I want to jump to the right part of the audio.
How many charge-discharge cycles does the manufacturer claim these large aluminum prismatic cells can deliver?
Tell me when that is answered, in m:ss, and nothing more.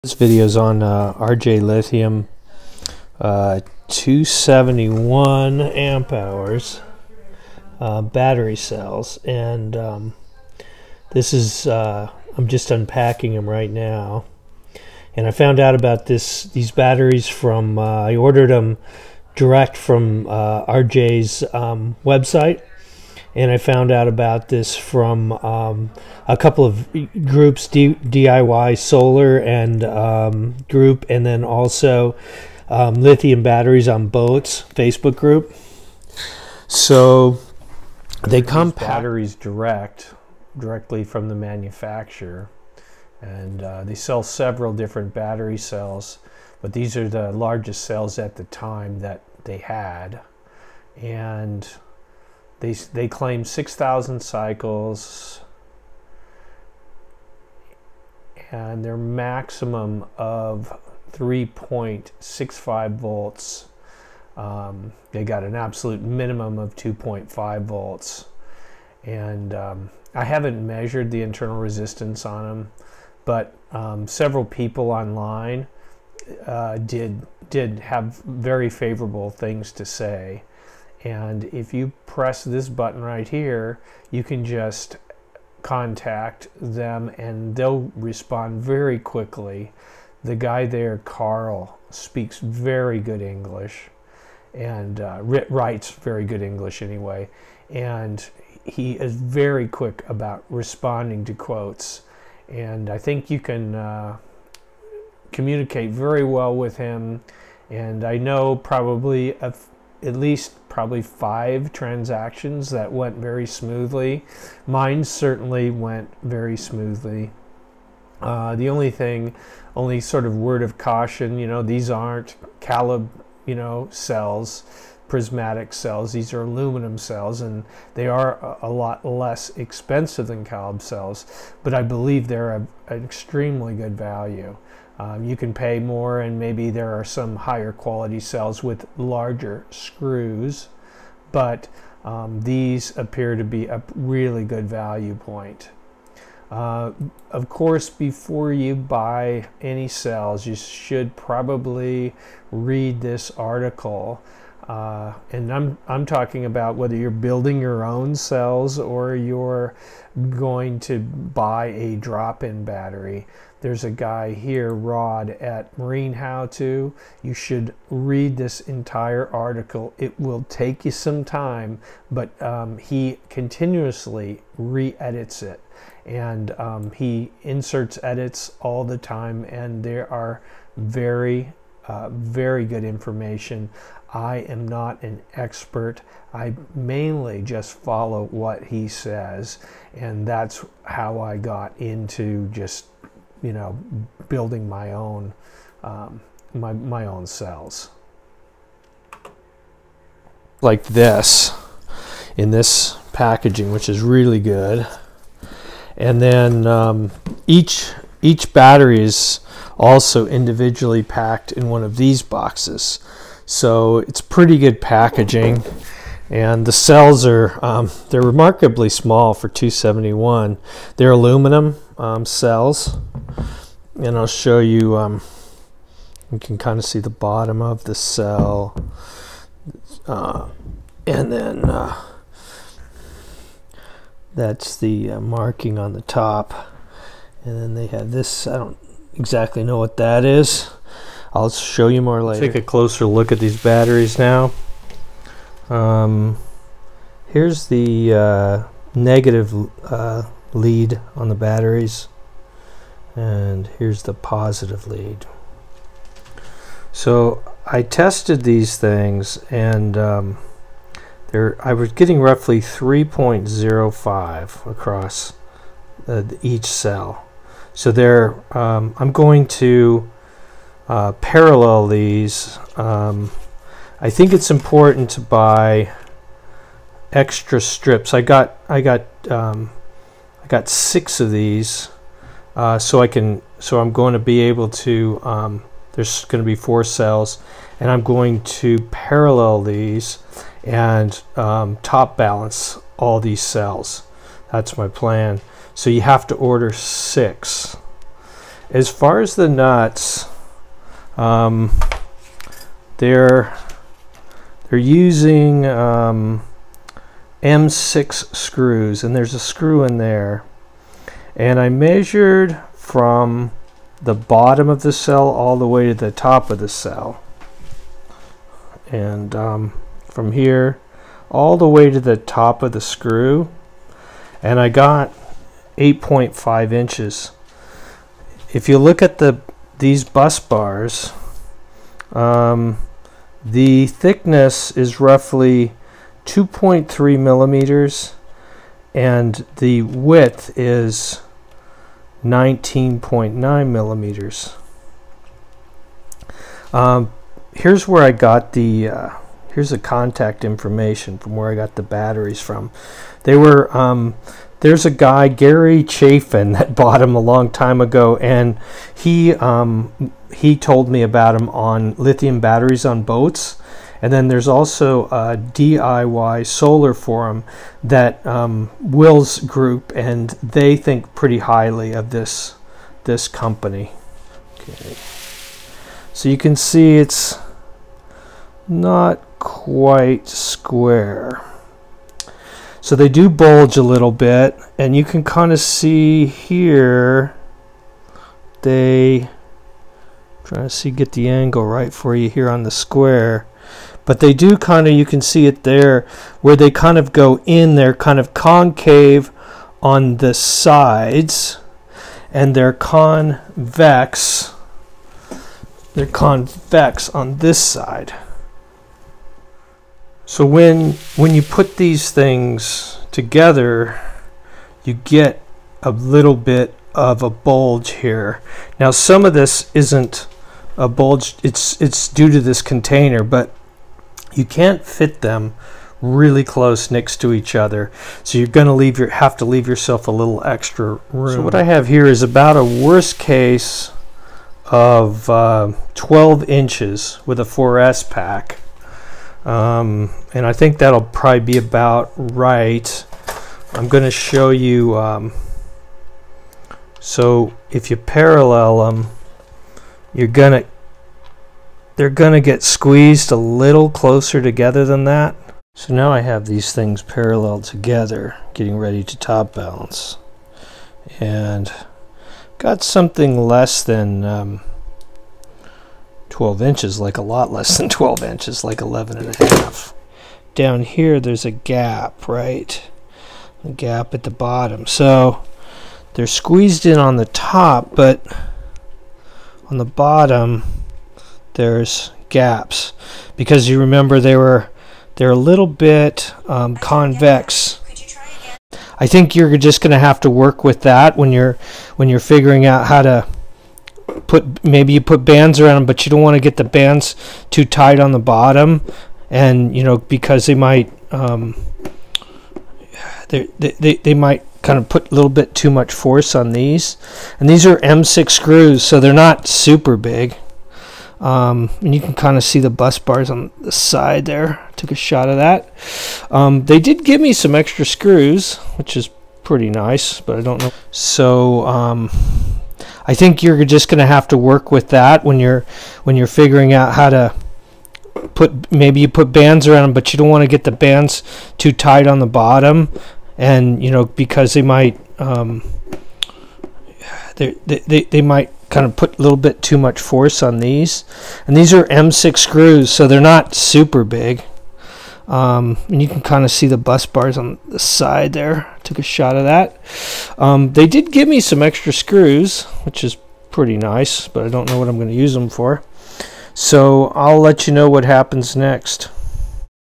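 0:53.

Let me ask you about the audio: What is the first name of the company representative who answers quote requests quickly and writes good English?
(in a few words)
Carl.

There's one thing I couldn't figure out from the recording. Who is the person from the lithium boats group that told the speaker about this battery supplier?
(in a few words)
Gary Chafin.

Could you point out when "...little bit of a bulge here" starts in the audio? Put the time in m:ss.
6:55.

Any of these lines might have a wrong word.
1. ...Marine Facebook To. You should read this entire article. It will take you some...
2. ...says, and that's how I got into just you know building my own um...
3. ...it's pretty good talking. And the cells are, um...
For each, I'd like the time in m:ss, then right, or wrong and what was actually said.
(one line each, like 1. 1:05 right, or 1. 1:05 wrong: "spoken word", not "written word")
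1. 2:45 wrong: "How", not "Facebook"
2. 3:08 right
3. 3:33 wrong: "packaging", not "talking".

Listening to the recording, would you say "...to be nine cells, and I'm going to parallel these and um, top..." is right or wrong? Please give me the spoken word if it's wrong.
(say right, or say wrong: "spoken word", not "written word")
wrong: "four", not "nine".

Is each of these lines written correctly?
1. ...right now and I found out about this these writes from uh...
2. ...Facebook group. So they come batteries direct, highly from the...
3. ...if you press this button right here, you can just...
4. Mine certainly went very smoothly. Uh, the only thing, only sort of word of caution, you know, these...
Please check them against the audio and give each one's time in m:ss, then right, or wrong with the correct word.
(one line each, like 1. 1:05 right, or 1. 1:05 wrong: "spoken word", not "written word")
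1. 0:13 wrong: "batteries", not "writes"
2. 0:34 wrong: "directly", not "highly"
3. 1:21 right
4. 1:54 right.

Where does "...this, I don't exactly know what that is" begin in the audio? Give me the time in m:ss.
3:58.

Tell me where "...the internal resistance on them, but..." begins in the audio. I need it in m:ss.
1:11.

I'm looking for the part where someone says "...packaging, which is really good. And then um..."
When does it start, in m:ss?
3:23.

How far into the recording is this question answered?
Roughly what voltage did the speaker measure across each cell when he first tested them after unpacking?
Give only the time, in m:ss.
4:22.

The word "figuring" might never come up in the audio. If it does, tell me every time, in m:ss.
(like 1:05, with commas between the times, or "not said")
8:12, 8:46.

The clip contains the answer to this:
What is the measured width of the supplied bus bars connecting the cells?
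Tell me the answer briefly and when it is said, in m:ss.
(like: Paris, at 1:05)
19.9 millimeters, at 5:42.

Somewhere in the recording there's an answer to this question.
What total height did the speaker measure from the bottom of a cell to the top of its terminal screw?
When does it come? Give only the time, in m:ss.
5:25.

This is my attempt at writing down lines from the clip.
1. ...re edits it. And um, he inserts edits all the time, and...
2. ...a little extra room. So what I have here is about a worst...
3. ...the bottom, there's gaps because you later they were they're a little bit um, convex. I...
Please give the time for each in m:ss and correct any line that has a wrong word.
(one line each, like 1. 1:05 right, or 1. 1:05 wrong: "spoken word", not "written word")
1. 2:54 right
2. 7:10 right
3. 7:59 wrong: "remember", not "later".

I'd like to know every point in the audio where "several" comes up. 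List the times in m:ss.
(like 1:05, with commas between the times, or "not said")
0:44, 1:14.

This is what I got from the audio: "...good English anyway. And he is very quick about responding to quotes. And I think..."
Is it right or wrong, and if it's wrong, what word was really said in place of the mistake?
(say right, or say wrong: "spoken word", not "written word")
right.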